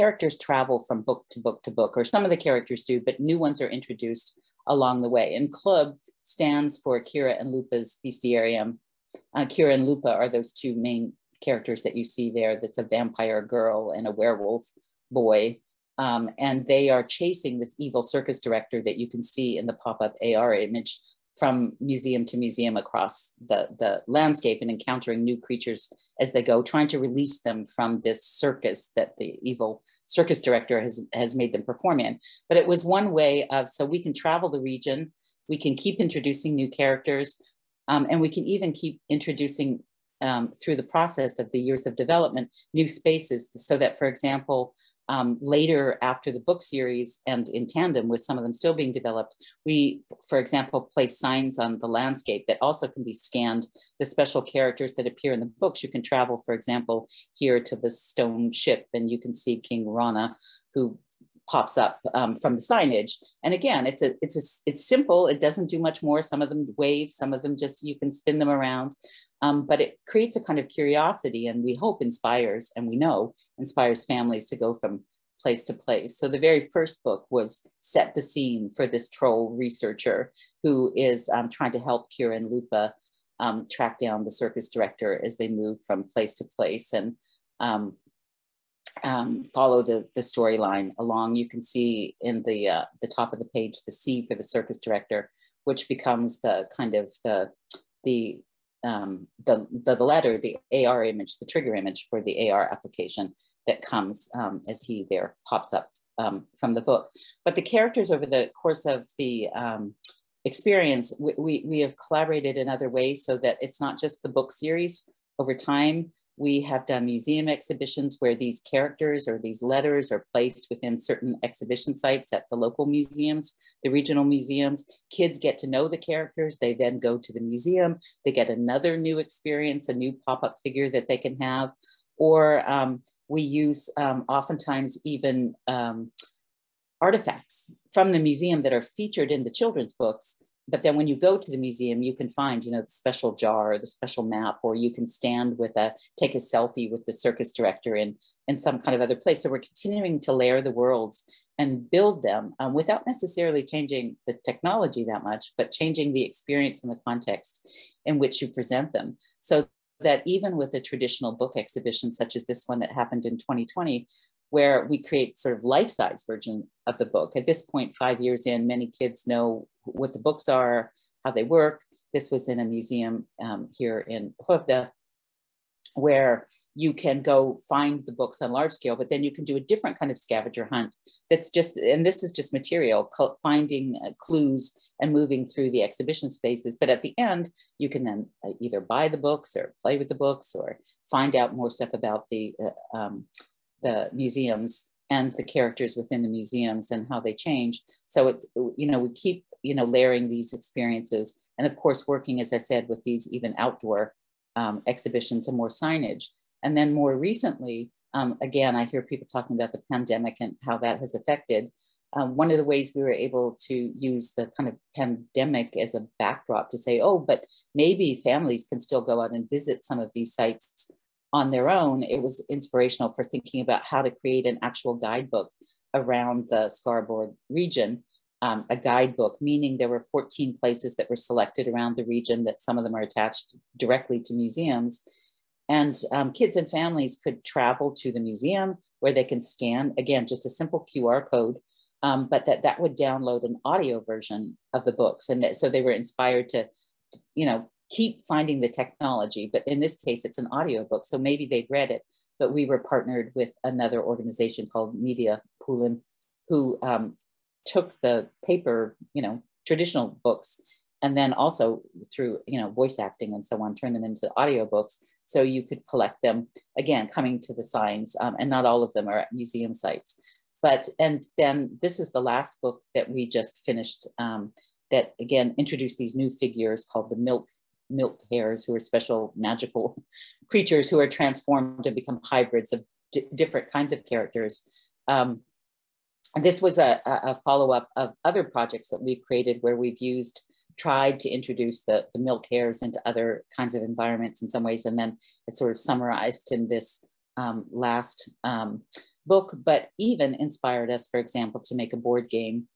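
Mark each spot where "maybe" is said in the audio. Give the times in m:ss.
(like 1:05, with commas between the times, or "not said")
3:37, 4:11.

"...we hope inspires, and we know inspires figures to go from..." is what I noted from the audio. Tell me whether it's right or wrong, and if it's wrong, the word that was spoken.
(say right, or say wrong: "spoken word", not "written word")
wrong: "families", not "figures".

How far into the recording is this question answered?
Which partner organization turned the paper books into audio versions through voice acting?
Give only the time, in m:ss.
4:14.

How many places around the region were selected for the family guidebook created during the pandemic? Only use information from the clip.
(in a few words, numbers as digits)
14.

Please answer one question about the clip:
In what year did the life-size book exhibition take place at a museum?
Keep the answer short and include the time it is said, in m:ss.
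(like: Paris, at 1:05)
2020, at 2:43.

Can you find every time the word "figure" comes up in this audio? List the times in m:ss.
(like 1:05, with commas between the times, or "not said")
2:10, 4:36.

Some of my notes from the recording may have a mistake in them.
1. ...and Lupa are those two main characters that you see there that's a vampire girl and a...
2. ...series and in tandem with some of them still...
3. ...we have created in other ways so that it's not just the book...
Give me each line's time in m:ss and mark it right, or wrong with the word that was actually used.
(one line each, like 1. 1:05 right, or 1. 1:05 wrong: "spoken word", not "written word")
1. 0:09 right
2. 0:46 right
3. 1:51 wrong: "collaborated", not "created".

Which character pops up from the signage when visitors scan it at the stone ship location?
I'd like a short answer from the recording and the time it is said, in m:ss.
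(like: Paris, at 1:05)
King Rana, at 0:59.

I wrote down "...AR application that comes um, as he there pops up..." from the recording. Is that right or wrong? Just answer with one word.
right.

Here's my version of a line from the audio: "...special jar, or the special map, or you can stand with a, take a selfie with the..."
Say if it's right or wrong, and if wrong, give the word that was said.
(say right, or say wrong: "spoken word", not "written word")
right.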